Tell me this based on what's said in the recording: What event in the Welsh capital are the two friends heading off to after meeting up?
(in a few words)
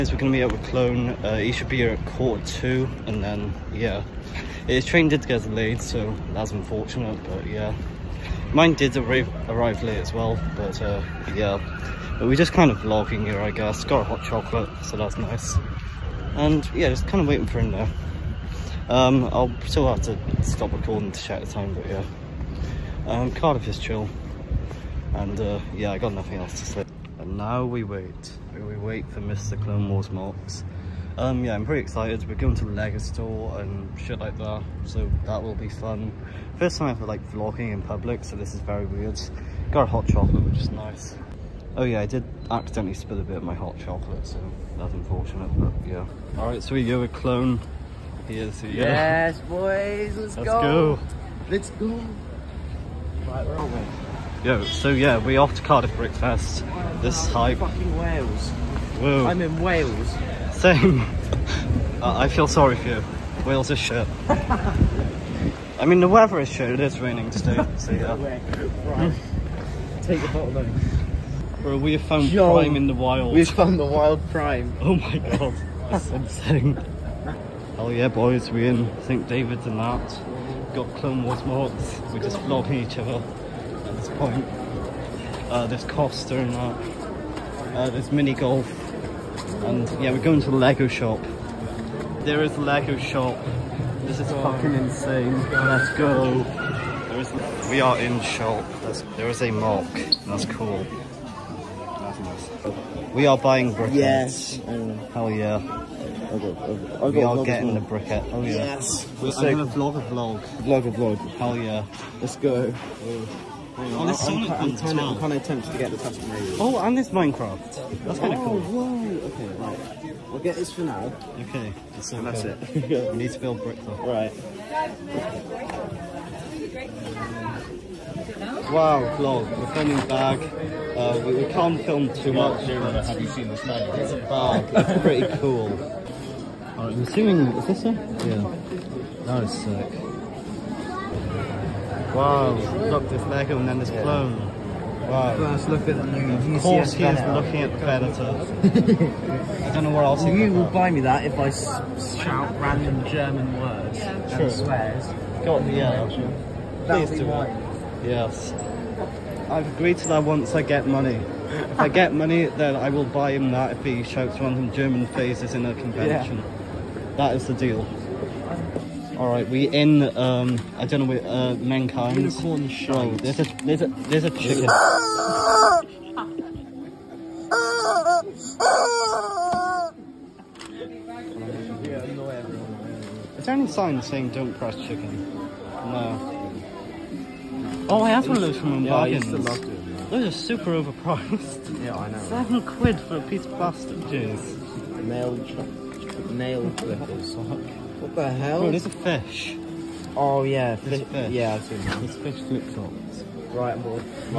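Cardiff Brickfest.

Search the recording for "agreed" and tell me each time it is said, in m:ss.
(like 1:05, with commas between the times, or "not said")
2:39.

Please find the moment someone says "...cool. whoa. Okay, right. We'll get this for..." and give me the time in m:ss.
1:58.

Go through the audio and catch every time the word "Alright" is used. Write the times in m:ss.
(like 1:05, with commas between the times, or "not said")
0:46, 2:16.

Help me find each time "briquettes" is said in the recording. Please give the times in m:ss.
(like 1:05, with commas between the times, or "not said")
1:43, 1:47.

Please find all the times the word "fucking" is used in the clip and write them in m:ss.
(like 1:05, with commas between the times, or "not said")
0:57, 1:34.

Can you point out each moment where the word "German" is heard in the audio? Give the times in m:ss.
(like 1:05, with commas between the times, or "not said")
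2:33, 2:44.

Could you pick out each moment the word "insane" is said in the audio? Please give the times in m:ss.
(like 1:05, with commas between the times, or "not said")
1:16, 1:34.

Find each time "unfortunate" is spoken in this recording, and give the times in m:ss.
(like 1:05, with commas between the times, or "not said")
0:06, 0:44.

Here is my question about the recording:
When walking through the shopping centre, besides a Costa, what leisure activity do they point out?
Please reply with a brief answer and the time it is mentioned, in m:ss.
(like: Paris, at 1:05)
Mini golf, at 1:28.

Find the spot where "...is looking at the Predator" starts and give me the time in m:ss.
2:27.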